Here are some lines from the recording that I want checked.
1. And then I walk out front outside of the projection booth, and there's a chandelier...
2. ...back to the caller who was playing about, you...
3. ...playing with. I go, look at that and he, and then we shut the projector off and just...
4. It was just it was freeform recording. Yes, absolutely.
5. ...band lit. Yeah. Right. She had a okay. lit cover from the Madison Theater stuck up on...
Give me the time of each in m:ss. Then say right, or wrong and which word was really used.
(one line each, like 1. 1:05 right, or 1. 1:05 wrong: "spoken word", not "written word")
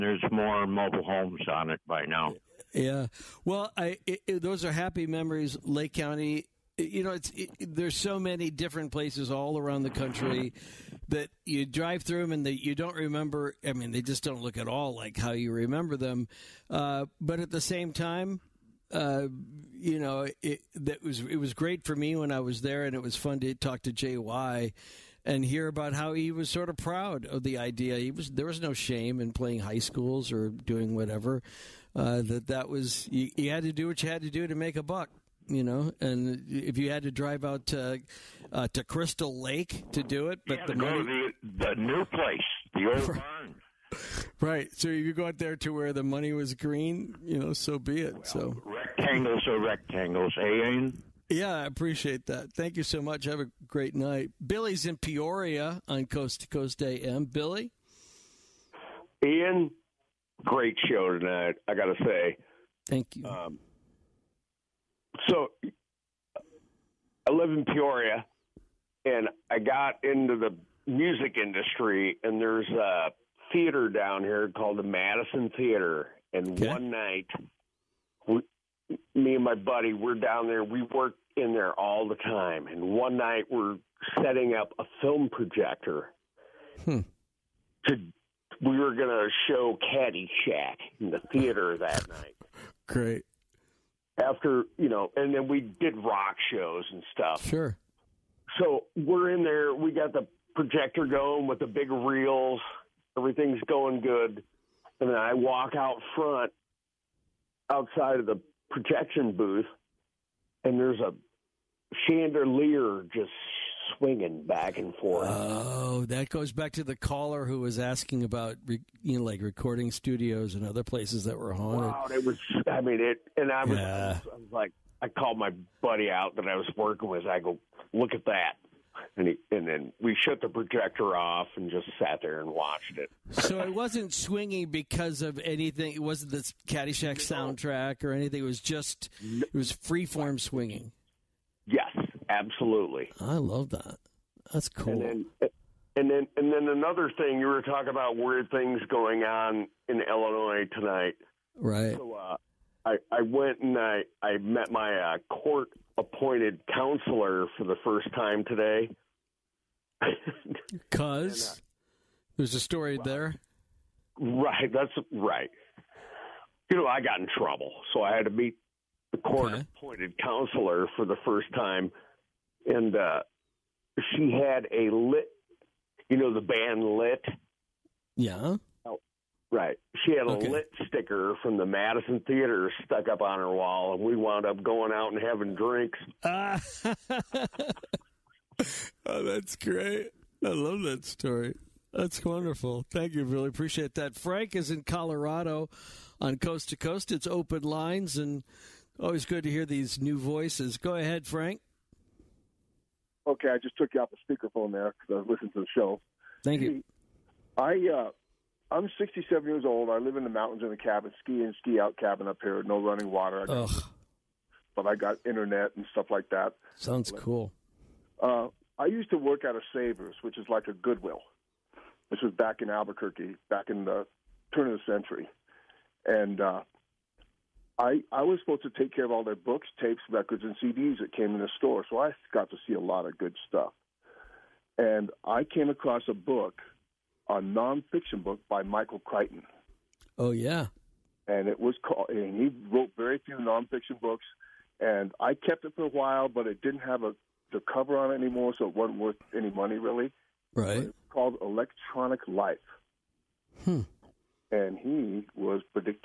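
1. 1:45 right
2. 1:56 wrong: "asking", not "playing"
3. 2:06 wrong: "working", not "playing"
4. 2:18 wrong: "swinging", not "recording"
5. 2:56 wrong: "sticker", not "cover".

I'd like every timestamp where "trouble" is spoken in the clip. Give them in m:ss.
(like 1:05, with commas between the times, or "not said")
2:47.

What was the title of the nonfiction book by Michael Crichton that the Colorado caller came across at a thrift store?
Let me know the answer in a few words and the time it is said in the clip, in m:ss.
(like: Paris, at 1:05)
Electronic Life, at 4:11.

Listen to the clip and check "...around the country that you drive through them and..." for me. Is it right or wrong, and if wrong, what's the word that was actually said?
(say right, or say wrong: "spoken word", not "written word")
right.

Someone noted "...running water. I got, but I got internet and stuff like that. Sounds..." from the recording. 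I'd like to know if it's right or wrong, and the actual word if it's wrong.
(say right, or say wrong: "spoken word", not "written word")
right.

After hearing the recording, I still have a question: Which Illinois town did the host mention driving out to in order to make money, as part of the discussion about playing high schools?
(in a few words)
Crystal Lake.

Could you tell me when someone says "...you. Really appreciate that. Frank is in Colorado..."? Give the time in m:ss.
3:13.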